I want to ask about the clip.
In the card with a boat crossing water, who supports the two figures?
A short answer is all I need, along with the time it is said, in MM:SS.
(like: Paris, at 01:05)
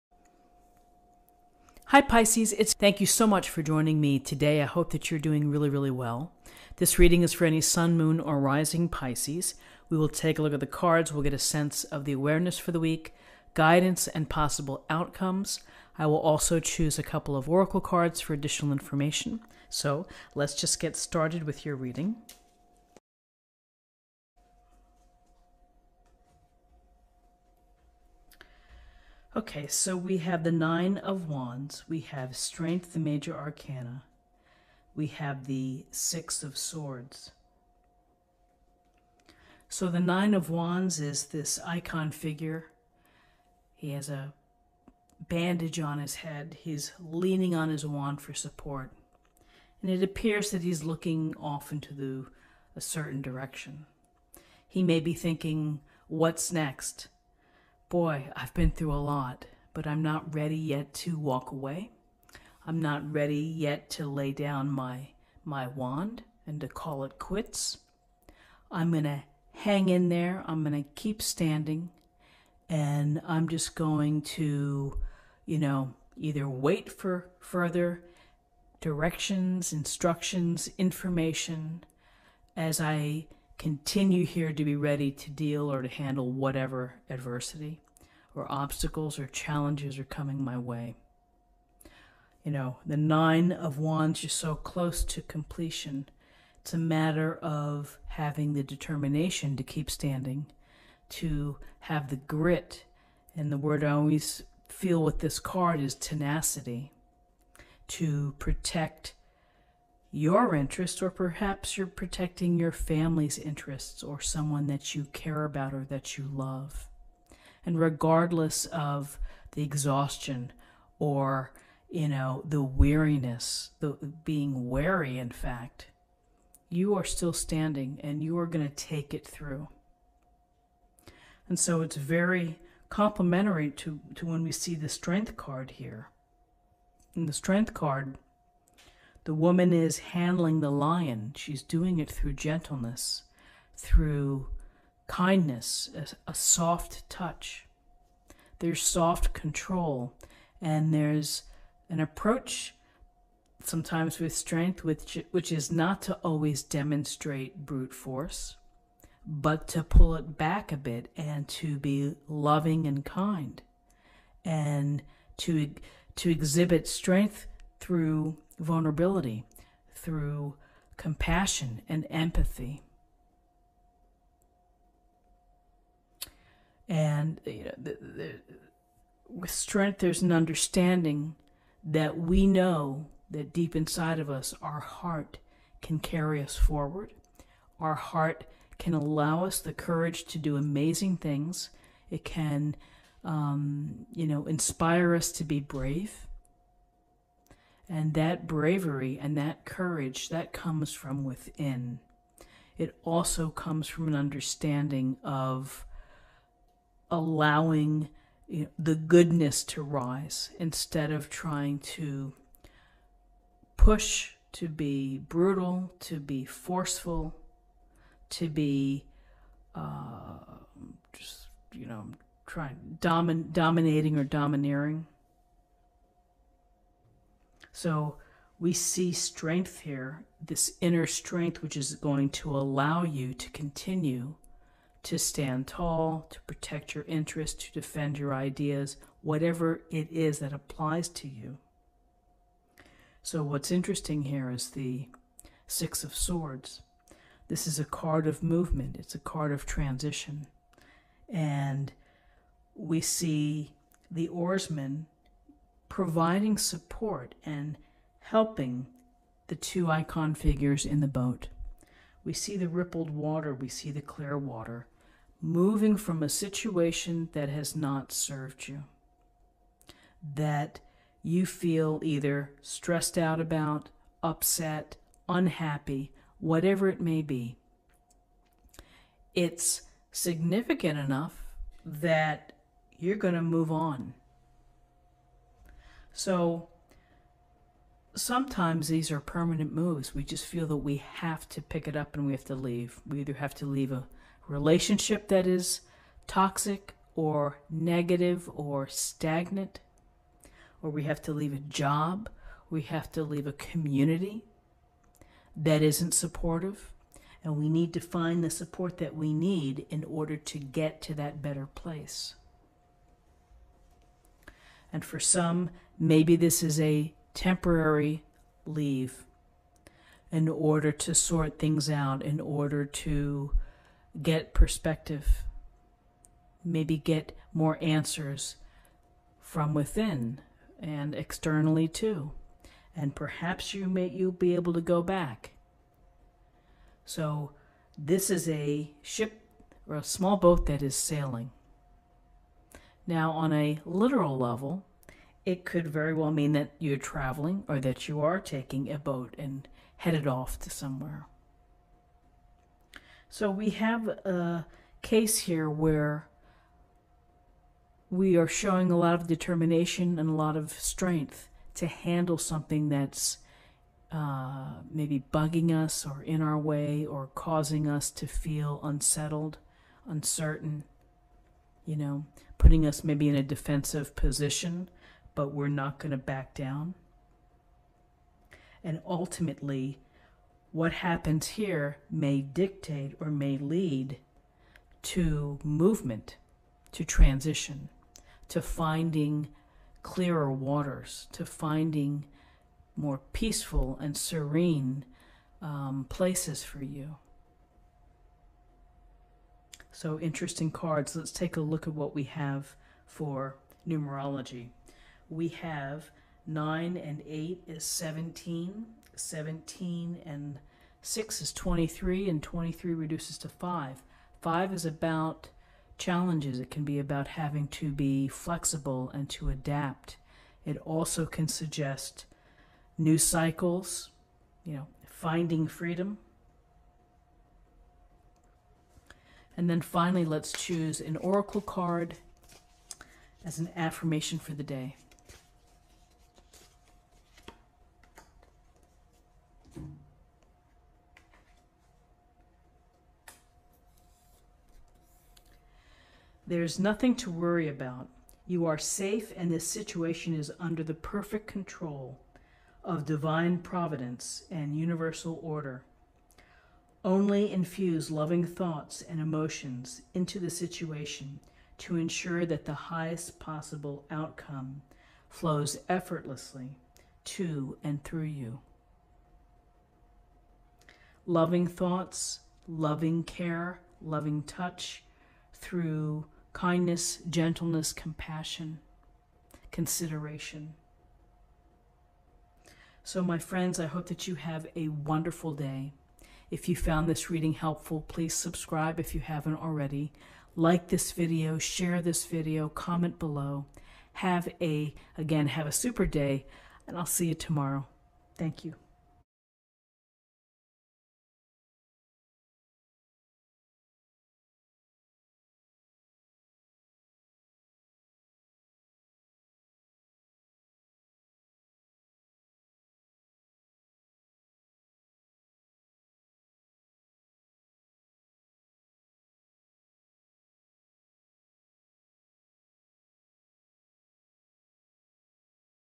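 the oarsman, at 04:14.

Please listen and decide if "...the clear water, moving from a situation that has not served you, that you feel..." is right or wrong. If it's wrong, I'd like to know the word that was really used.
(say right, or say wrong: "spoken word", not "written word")
right.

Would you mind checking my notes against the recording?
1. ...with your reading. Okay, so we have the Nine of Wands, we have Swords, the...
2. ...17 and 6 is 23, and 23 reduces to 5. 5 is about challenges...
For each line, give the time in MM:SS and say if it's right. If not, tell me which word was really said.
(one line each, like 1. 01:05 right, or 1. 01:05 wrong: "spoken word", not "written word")
1. 00:21 wrong: "Strength", not "Swords"
2. 06:49 right.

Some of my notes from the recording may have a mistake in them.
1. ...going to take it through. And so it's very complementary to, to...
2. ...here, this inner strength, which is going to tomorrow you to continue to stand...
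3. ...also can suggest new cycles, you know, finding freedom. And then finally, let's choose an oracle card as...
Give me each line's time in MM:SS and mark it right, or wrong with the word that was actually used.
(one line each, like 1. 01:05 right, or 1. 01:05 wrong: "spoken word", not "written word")
1. 02:08 right
2. 03:49 wrong: "allow", not "tomorrow"
3. 07:00 right.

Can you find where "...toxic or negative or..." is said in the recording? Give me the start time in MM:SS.
04:56.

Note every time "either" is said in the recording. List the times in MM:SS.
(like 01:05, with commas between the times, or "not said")
01:16, 04:32, 04:53.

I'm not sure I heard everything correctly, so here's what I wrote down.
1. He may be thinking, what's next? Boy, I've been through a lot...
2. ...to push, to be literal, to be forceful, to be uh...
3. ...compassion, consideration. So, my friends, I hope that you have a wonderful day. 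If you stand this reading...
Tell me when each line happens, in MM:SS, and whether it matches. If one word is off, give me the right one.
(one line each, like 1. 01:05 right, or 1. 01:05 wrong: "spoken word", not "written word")
1. 00:54 right
2. 03:31 wrong: "brutal", not "literal"
3. 07:57 wrong: "found", not "stand".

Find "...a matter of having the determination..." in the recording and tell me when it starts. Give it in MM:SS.
01:36.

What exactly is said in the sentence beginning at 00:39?
So the Nine of Wands is this icon figure.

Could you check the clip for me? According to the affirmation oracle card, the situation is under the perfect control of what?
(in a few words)
divine providence.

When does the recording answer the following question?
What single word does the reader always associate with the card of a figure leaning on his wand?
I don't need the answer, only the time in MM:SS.
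01:45.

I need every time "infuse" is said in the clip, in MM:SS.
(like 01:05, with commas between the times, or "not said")
07:37.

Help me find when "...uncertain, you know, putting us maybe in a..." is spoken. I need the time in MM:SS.
06:10.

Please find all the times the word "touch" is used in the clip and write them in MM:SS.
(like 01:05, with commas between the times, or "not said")
02:27, 07:54.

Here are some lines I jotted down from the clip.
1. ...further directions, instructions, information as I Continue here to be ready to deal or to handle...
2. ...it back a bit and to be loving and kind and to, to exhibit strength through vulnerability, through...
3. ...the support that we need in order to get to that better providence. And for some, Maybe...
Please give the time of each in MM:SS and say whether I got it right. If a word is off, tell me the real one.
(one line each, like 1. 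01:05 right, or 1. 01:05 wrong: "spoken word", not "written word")
1. 01:17 right
2. 02:40 right
3. 05:08 wrong: "place", not "providence".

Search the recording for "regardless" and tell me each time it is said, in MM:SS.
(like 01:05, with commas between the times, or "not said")
01:57.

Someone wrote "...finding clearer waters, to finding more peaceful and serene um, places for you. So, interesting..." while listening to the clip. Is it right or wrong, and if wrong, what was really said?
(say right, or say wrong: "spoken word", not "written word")
right.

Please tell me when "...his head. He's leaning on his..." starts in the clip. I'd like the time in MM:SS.
00:45.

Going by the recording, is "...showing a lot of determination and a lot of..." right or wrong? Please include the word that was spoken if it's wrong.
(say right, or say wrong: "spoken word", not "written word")
right.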